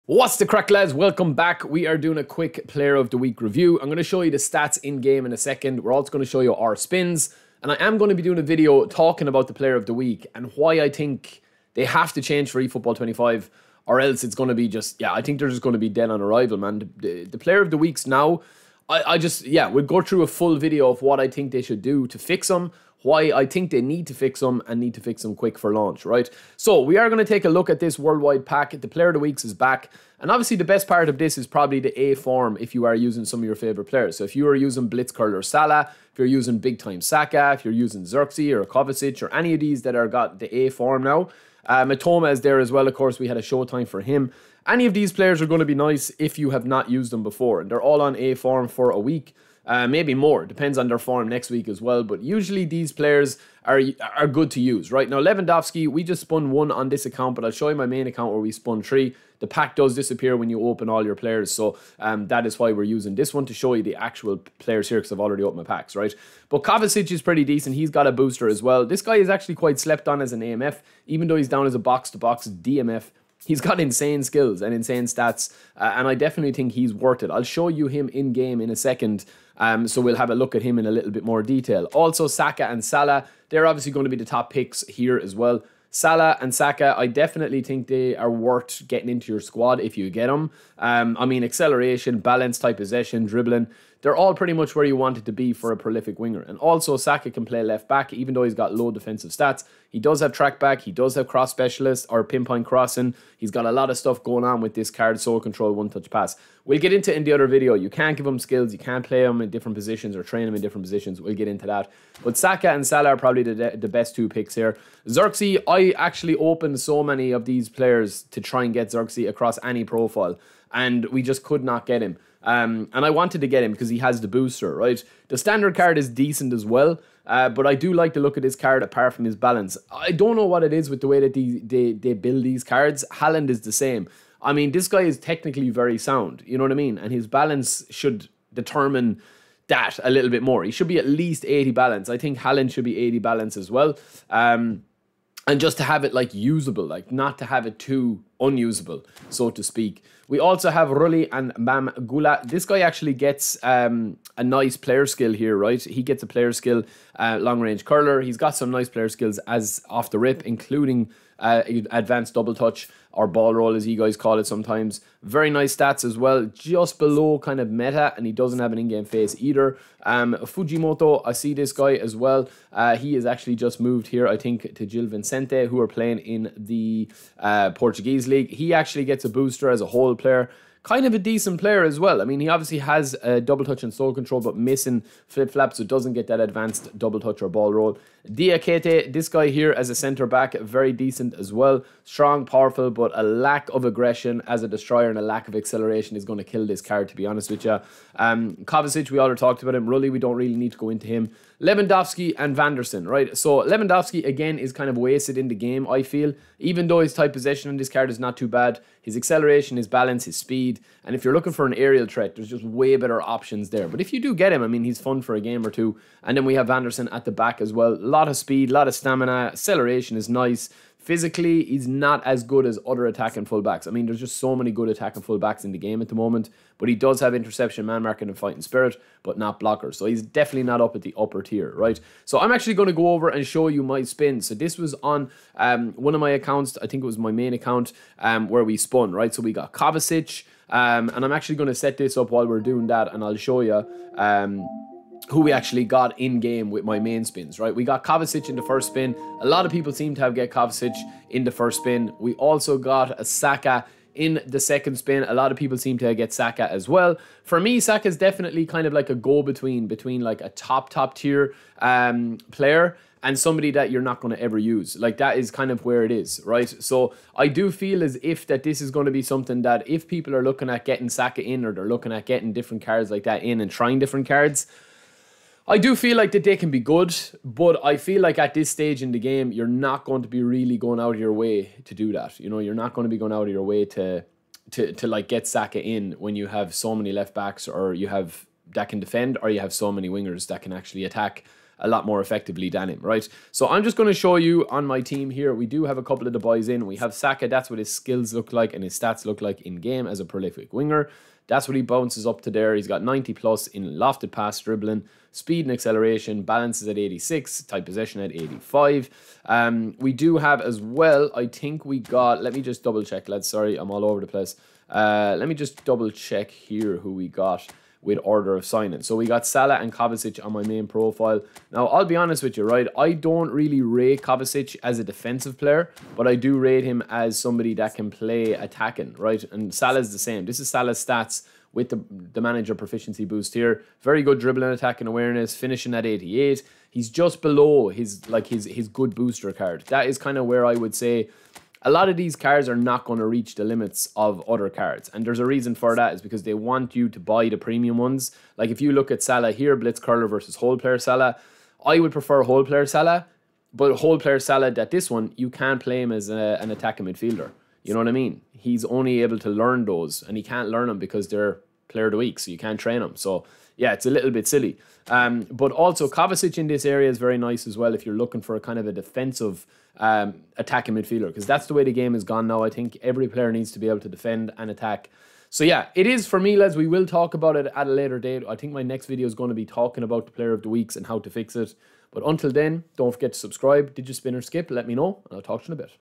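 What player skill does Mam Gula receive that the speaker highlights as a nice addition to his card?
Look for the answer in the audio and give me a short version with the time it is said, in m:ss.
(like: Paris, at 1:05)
Long range curler, at 2:37.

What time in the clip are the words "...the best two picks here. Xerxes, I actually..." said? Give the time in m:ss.
1:53.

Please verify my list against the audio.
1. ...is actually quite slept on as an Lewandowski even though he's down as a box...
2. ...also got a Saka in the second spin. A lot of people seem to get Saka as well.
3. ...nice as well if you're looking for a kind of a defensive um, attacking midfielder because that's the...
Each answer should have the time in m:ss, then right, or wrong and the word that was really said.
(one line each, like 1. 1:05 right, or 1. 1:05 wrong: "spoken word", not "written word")
1. 1:09 wrong: "AMF", not "Lewandowski"
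2. 4:12 right
3. 6:07 right.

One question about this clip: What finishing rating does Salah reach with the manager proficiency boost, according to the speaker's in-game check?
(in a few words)
88.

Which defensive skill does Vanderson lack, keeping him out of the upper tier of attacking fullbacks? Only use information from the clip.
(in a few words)
Blockers.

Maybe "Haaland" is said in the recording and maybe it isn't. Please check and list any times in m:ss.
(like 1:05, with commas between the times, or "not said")
2:13, 2:22.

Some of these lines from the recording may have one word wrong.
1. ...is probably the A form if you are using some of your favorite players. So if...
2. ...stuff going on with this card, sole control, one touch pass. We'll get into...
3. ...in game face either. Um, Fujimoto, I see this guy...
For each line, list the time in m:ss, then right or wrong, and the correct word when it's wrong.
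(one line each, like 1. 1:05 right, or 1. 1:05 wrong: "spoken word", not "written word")
1. 0:31 right
2. 1:43 right
3. 2:48 right.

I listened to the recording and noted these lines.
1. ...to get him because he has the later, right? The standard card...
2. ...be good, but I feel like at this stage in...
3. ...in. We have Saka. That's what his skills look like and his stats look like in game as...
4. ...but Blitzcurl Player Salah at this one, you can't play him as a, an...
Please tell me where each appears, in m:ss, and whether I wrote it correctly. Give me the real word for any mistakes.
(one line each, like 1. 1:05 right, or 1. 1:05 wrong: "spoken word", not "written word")
1. 2:03 wrong: "booster", not "later"
2. 4:36 right
3. 4:56 right
4. 5:53 wrong: "Whole", not "Blitzcurl".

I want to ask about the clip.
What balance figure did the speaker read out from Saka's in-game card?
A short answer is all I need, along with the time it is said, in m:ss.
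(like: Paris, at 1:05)
86, at 5:06.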